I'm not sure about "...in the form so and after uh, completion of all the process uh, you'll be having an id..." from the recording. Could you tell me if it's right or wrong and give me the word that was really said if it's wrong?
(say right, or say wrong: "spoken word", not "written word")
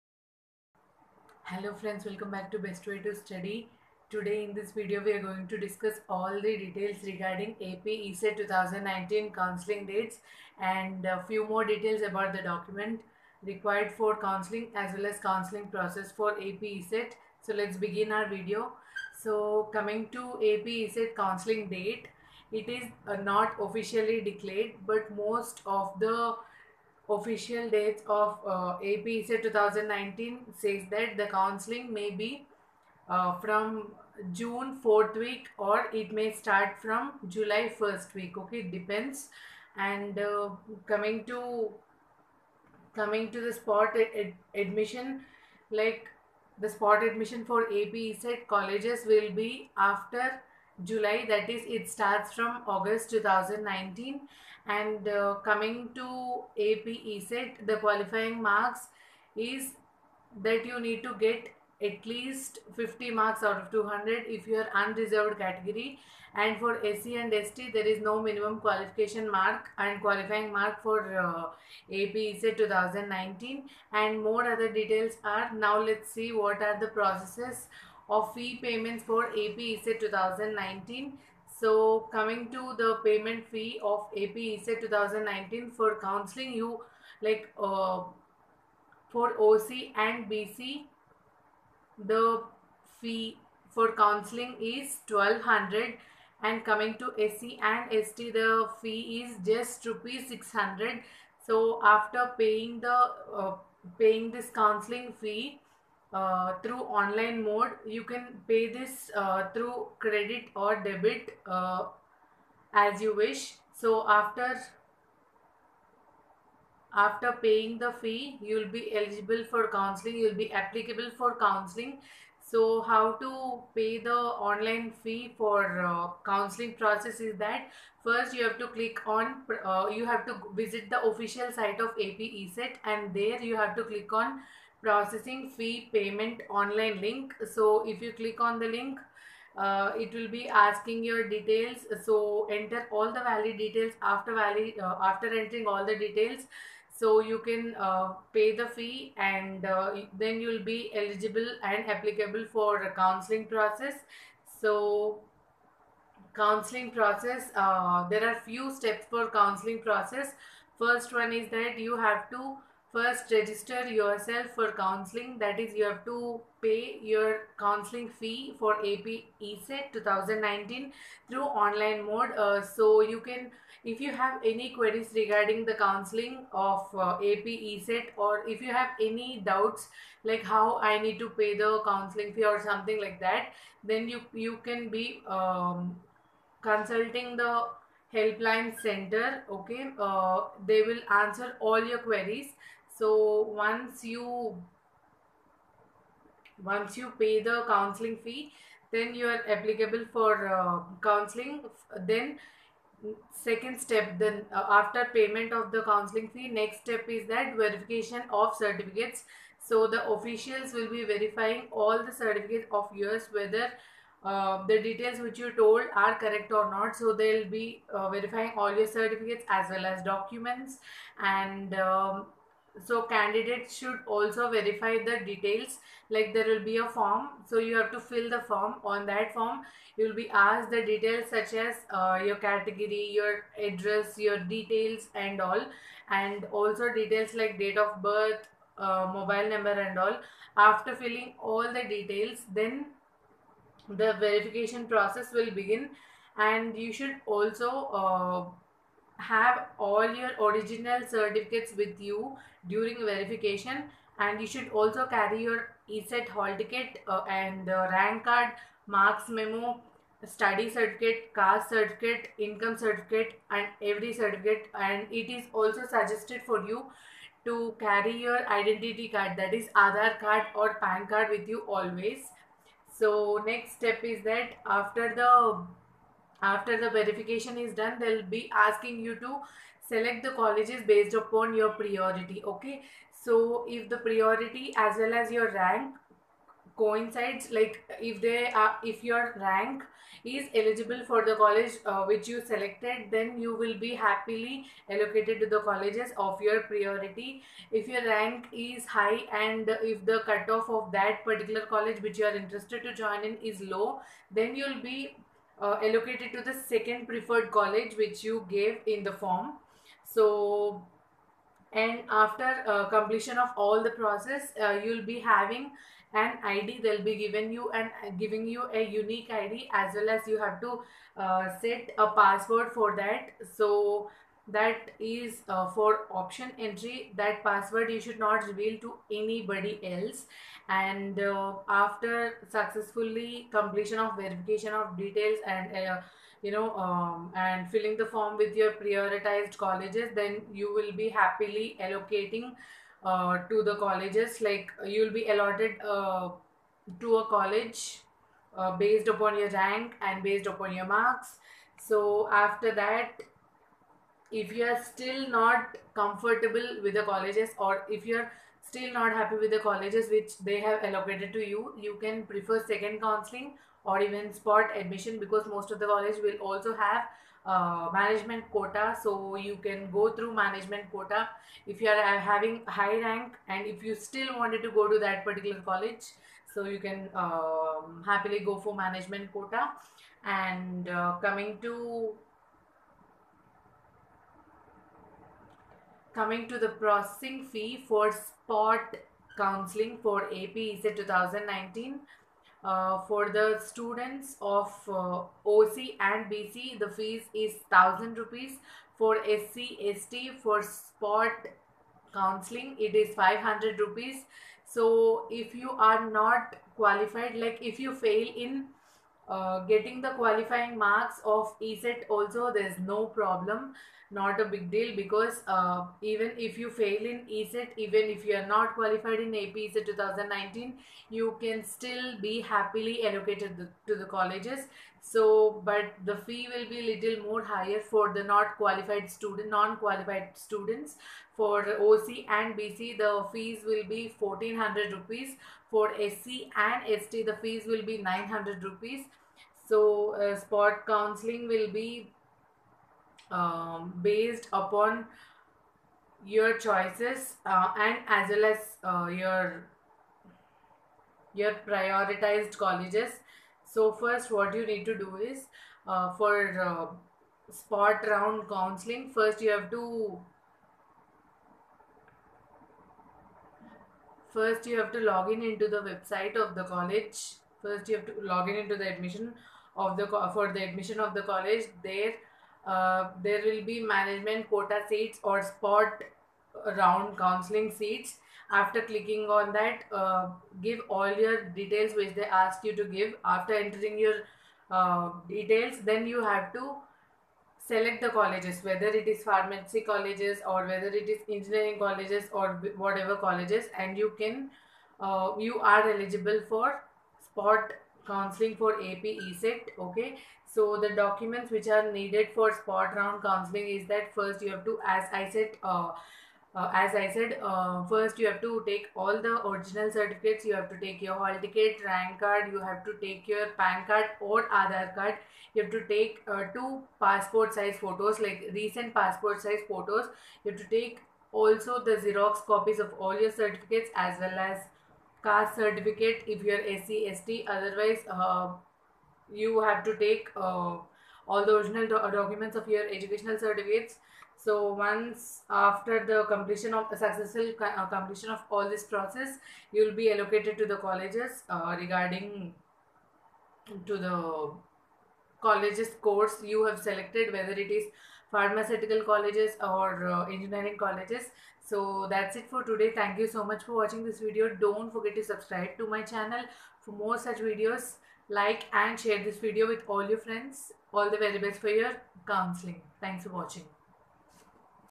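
right.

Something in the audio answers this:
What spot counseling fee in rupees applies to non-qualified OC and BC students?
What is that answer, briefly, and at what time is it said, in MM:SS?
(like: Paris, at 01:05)
1400, at 07:14.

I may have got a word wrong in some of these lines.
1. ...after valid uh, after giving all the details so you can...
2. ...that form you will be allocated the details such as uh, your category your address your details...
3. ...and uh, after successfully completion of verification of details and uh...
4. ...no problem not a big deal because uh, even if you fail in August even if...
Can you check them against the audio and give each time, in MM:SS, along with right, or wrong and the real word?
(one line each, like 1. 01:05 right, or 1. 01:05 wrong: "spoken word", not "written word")
1. 02:24 wrong: "entering", not "giving"
2. 03:49 wrong: "asked", not "allocated"
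3. 05:30 right
4. 06:52 wrong: "ECET", not "August".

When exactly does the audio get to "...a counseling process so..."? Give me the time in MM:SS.
02:32.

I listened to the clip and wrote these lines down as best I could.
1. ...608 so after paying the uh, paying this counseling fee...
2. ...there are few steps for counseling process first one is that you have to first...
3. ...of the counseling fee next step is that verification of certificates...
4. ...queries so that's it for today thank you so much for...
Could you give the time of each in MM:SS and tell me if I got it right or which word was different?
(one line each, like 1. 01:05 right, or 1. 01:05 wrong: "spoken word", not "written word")
1. 01:40 wrong: "600", not "608"
2. 02:38 right
3. 03:25 right
4. 09:10 wrong: "colleges", not "queries".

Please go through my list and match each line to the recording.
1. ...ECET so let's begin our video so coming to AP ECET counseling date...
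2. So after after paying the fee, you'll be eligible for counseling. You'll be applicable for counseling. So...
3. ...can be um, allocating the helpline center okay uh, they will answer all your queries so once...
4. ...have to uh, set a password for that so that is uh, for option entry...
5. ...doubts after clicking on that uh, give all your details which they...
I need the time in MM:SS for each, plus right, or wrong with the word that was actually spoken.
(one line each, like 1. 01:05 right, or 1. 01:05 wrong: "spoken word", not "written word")
1. 00:16 right
2. 01:53 right
3. 03:04 wrong: "consulting", not "allocating"
4. 05:20 right
5. 07:57 wrong: "seats", not "doubts".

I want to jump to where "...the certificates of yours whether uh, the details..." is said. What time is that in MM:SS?
03:32.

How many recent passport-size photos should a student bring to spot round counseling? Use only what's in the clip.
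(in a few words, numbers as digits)
2.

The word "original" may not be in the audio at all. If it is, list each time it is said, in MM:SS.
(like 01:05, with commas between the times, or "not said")
04:10, 08:29, 08:51.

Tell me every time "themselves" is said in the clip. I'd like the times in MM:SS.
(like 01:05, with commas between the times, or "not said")
not said.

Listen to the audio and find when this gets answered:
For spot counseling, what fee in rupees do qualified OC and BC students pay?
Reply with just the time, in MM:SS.
06:37.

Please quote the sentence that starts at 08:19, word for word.
Okay, so the documents which are needed for spot round counseling is that first you have to, as I said.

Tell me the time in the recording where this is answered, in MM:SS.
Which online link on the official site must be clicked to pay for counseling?
02:14.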